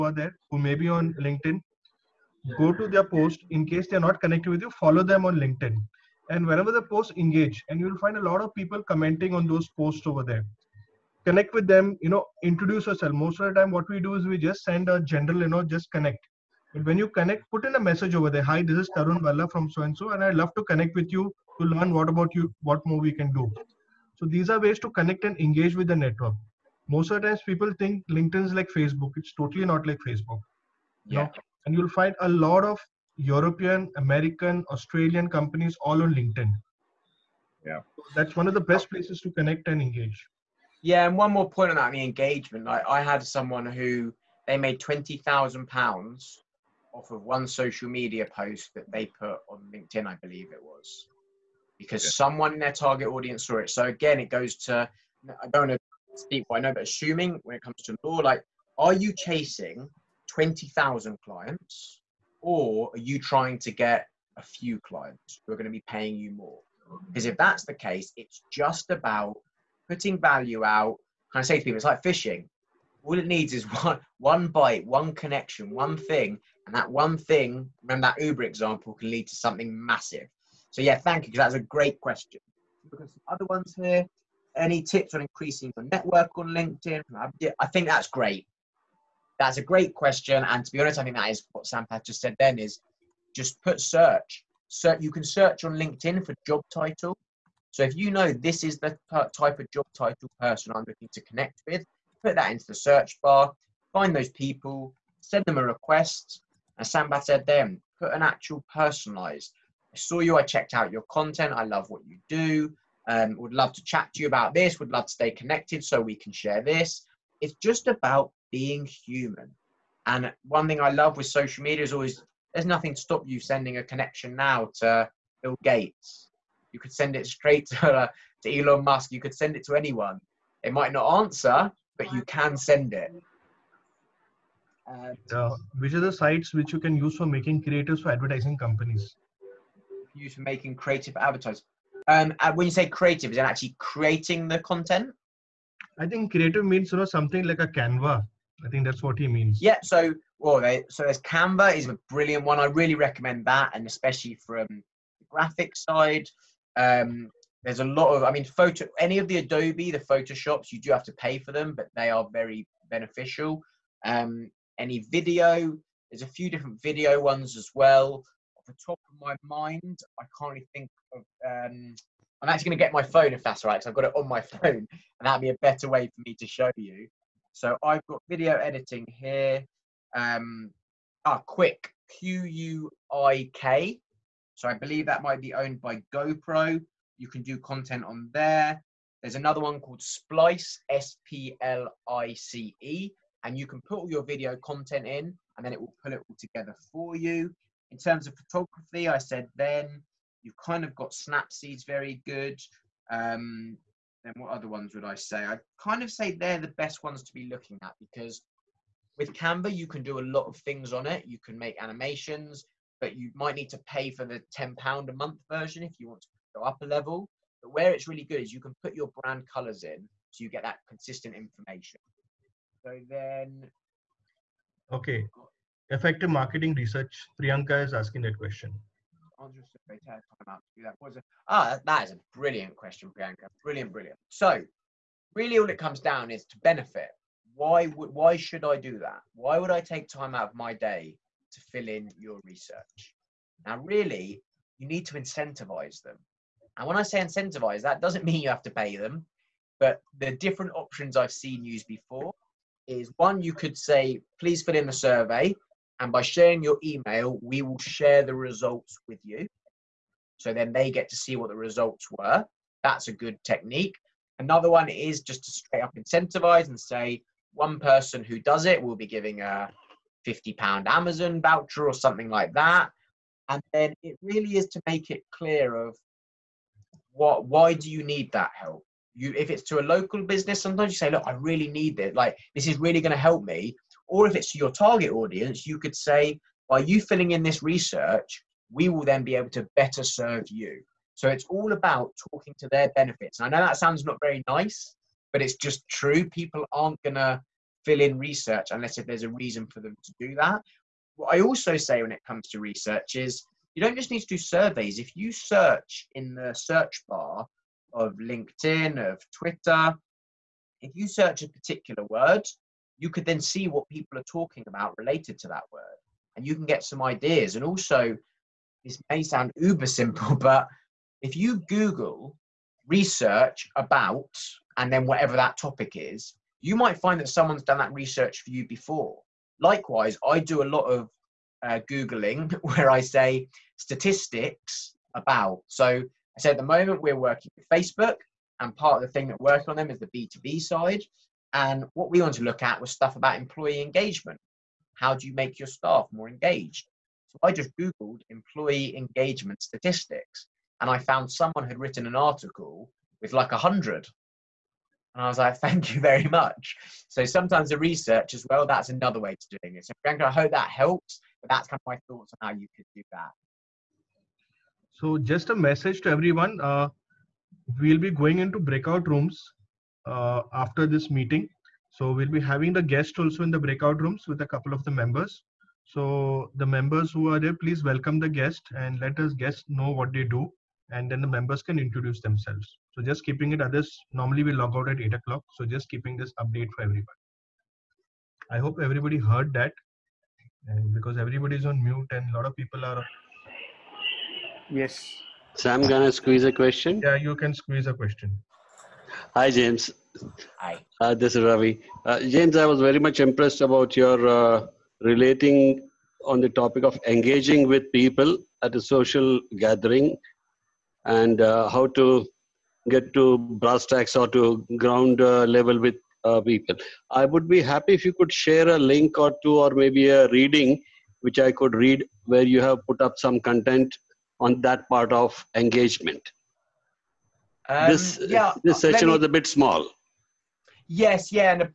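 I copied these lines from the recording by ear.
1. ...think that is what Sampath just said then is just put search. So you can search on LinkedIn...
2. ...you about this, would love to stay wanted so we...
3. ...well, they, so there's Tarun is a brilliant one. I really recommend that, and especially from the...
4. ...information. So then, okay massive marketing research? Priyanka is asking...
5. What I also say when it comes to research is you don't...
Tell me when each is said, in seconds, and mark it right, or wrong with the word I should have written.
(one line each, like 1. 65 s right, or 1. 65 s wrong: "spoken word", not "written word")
1. 91 s right
2. 114 s wrong: "connected", not "wanted"
3. 150 s wrong: "Canva", not "Tarun"
4. 221 s wrong: "effective", not "massive"
5. 301 s right.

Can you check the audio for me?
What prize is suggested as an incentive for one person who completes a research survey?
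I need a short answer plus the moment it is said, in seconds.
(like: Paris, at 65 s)
£50 Amazon voucher, at 270 s.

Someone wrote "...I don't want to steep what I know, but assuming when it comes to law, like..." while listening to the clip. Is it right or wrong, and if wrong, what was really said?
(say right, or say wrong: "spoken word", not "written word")
right.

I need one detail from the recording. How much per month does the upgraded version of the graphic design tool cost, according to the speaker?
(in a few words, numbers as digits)
10 pounds.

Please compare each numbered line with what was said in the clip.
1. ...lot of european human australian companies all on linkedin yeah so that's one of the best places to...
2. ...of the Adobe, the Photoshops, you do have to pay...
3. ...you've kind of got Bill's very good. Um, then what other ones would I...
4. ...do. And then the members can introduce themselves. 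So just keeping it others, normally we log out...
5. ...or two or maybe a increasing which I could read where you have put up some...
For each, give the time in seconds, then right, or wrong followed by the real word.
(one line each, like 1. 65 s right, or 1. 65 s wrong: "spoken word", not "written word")
1. 32 s wrong: "american", not "human"
2. 159 s right
3. 200 s wrong: "Snapseed", not "Bill"
4. 380 s right
5. 419 s wrong: "reading", not "increasing".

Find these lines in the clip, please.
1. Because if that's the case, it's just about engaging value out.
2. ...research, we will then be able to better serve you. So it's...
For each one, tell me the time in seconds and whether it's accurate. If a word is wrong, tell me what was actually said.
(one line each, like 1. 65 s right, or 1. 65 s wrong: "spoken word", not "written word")
1. 67 s wrong: "putting", not "engaging"
2. 287 s right.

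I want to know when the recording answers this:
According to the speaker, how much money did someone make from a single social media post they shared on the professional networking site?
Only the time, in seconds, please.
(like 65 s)
44 s.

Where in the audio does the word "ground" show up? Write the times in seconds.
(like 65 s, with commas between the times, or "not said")
414 s.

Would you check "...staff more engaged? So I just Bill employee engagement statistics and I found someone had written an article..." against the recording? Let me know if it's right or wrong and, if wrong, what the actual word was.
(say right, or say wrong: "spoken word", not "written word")
wrong: "Googled", not "Bill".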